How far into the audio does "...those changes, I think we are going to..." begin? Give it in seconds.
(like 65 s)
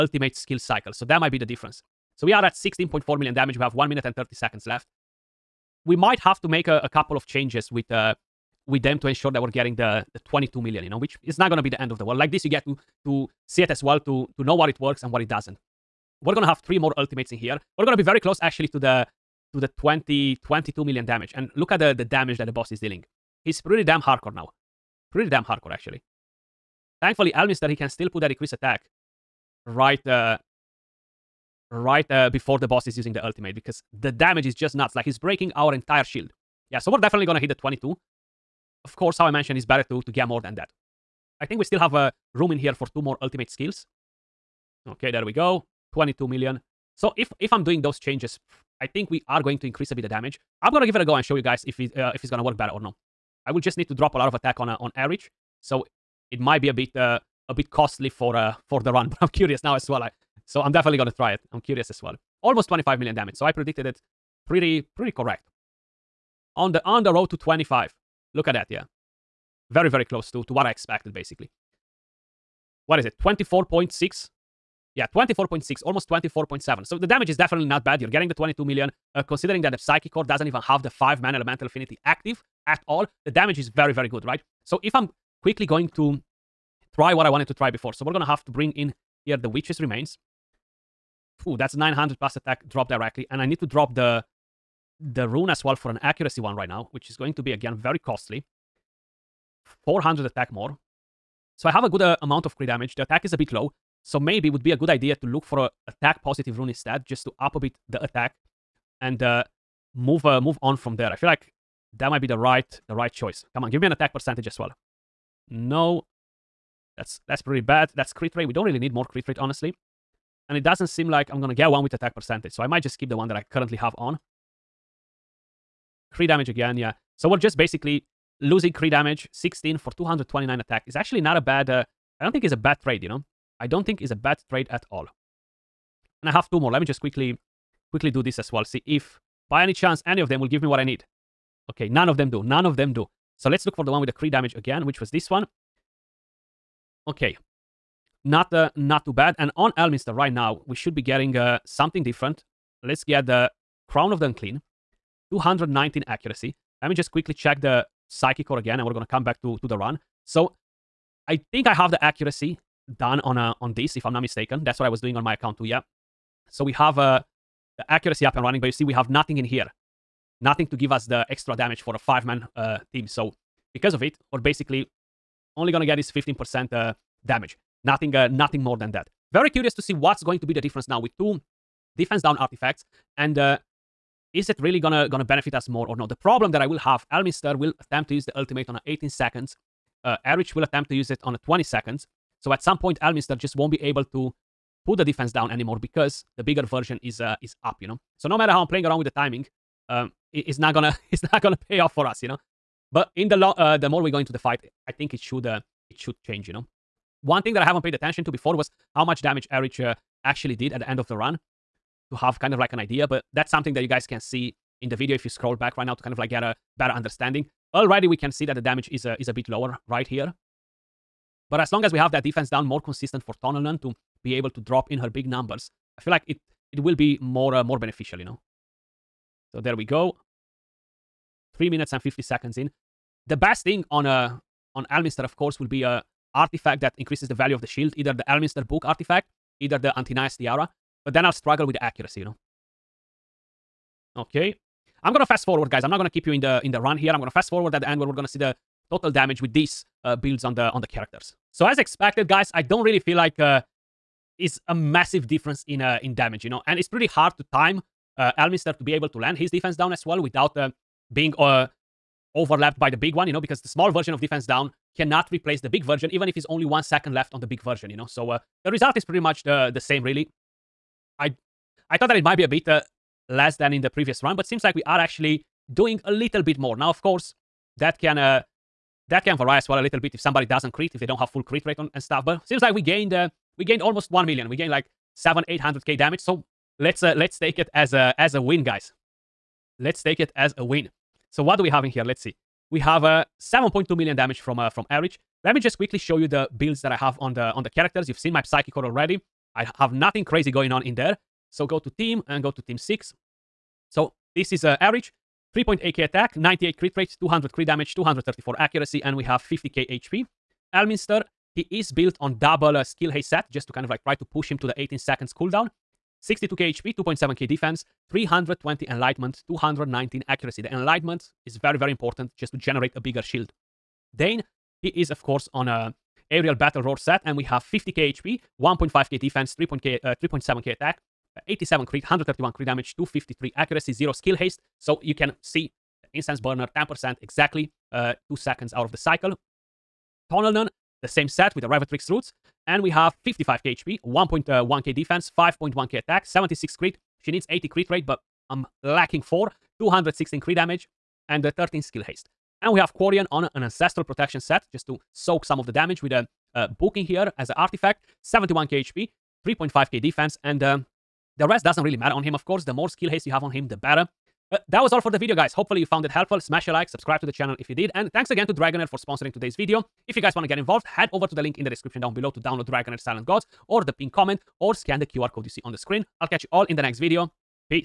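47 s.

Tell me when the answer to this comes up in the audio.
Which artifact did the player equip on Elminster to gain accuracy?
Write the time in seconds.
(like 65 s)
153 s.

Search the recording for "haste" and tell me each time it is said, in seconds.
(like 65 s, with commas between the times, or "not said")
313 s, 334 s, 352 s, 363 s.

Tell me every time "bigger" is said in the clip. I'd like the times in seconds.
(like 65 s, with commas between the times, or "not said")
196 s, 322 s.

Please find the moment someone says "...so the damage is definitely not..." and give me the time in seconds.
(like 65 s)
76 s.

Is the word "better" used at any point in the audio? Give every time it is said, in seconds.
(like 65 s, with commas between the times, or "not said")
39 s, 52 s, 216 s, 363 s.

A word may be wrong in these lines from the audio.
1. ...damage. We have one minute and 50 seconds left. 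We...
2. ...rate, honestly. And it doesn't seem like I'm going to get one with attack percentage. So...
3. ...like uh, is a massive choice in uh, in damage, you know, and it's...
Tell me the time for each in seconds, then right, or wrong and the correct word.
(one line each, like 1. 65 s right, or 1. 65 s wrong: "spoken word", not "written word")
1. 3 s wrong: "30", not "50"
2. 119 s right
3. 253 s wrong: "difference", not "choice".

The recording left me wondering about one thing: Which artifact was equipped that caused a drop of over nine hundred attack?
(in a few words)
Witch's Remains.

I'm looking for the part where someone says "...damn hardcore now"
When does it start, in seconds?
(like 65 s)
23 s.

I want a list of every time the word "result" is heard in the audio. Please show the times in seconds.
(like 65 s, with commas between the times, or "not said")
268 s.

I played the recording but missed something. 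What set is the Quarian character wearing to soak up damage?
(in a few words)
Ancestral Protection.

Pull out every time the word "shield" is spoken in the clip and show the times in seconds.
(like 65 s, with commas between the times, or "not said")
36 s, 237 s, 323 s.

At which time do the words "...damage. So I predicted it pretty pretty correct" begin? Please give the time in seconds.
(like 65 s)
63 s.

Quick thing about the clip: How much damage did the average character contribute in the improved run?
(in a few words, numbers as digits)
7.2 million.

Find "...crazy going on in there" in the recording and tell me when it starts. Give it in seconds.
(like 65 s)
300 s.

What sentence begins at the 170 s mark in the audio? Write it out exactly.
Nothing to give us the extra damage for a five-man uh, team.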